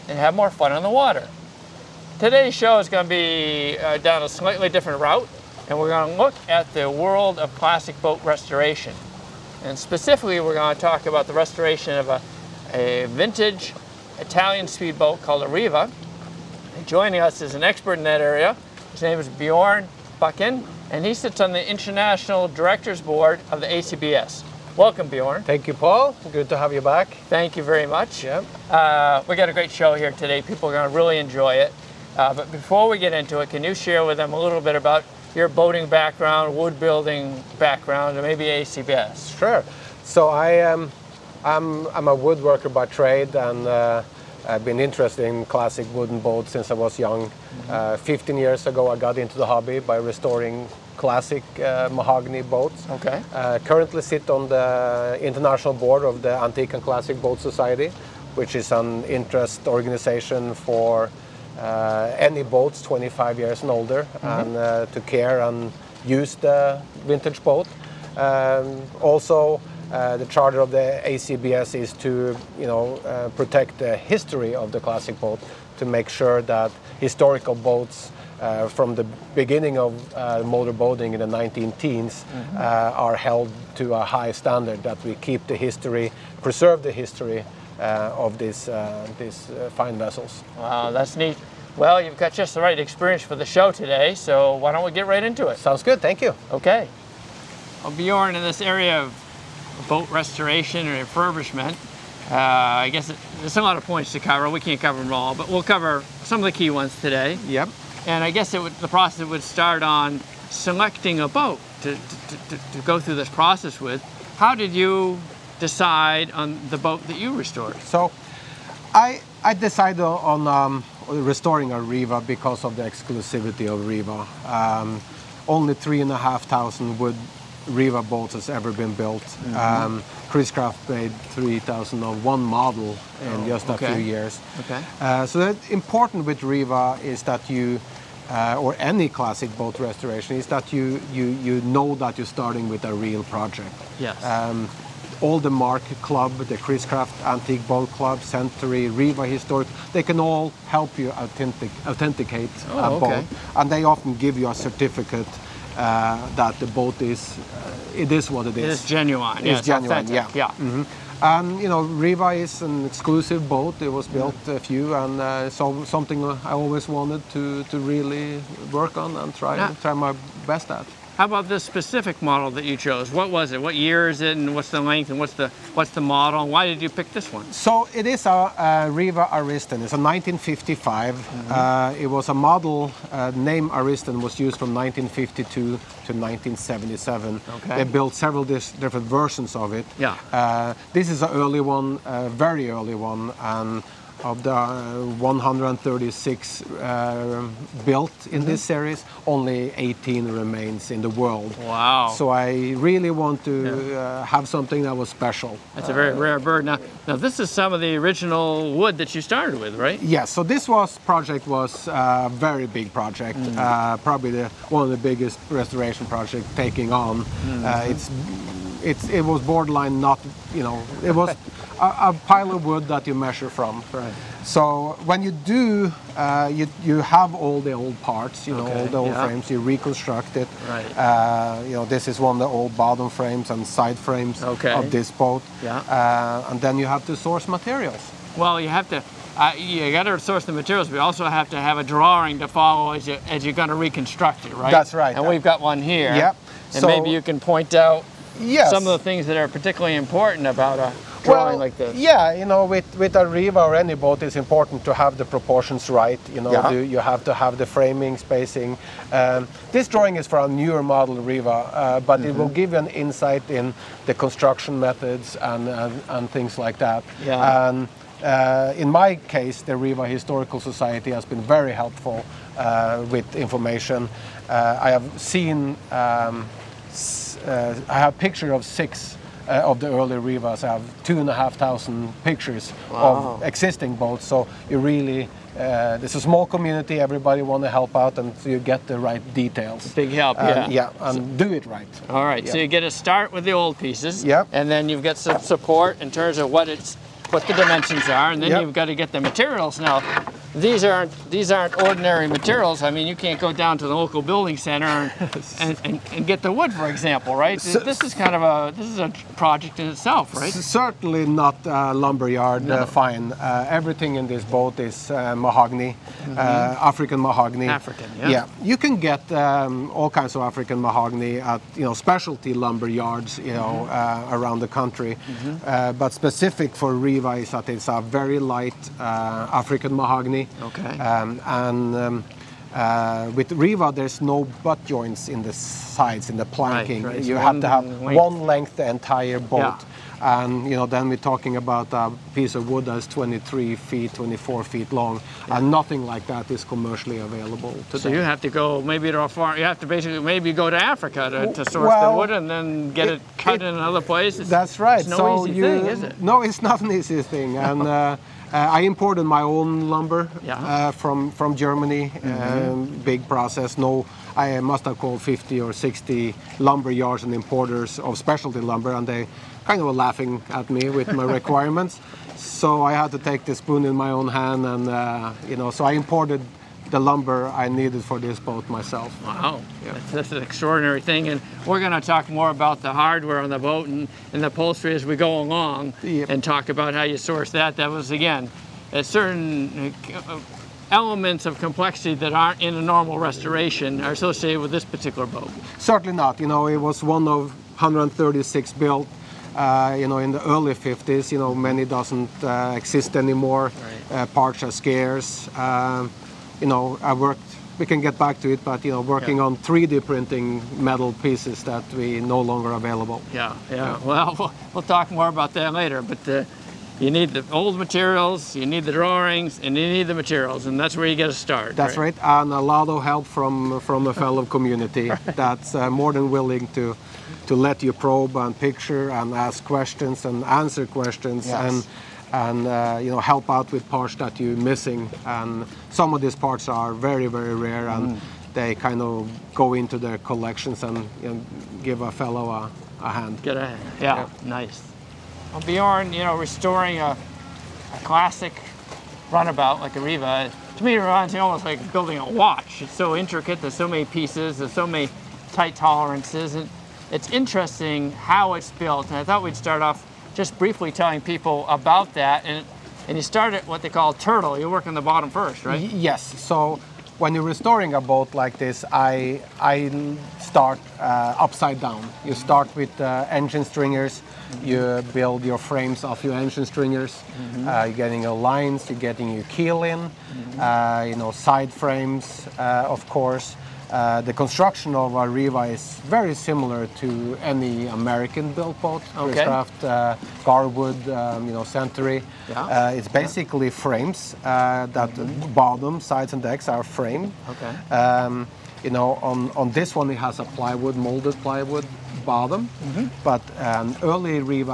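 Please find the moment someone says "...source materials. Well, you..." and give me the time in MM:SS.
03:57.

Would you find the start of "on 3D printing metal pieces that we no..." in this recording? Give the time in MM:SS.
06:49.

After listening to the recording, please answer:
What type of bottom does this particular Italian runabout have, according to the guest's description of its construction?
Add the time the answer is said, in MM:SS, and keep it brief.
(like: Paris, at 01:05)
molded plywood, at 08:20.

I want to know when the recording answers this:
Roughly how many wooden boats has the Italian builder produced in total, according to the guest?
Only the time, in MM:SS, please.
02:05.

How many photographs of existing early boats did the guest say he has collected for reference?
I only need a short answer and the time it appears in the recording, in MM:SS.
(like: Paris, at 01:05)
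2,500, at 04:41.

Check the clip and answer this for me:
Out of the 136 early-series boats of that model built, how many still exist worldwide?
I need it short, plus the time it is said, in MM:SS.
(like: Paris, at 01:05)
18, at 03:19.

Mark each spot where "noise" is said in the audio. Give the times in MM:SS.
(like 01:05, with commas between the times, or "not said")
not said.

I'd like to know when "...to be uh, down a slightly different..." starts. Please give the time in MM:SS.
00:03.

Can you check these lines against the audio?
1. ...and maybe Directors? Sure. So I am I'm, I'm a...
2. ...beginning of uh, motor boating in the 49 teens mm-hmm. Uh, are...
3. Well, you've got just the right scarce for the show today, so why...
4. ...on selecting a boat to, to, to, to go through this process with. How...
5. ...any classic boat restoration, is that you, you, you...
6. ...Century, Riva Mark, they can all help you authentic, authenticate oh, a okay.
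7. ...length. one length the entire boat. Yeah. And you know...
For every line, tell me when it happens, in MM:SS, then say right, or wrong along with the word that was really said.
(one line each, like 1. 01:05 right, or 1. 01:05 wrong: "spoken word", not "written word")
1. 00:38 wrong: "ACBS", not "Directors"
2. 01:19 wrong: "19", not "49"
3. 01:31 wrong: "experience", not "scarce"
4. 01:49 right
5. 02:18 right
6. 02:28 wrong: "Historic", not "Mark"
7. 05:38 right.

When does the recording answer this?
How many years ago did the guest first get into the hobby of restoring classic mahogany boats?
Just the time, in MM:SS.
00:47.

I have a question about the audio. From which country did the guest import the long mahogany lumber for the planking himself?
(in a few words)
Germany.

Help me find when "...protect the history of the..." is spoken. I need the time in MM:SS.
01:13.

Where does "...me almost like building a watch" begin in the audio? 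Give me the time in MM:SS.
07:31.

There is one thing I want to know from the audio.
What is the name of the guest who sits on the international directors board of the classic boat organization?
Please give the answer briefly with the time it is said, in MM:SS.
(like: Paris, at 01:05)
Bjorn Bucken, at 00:19.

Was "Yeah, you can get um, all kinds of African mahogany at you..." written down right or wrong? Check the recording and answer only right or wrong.
right.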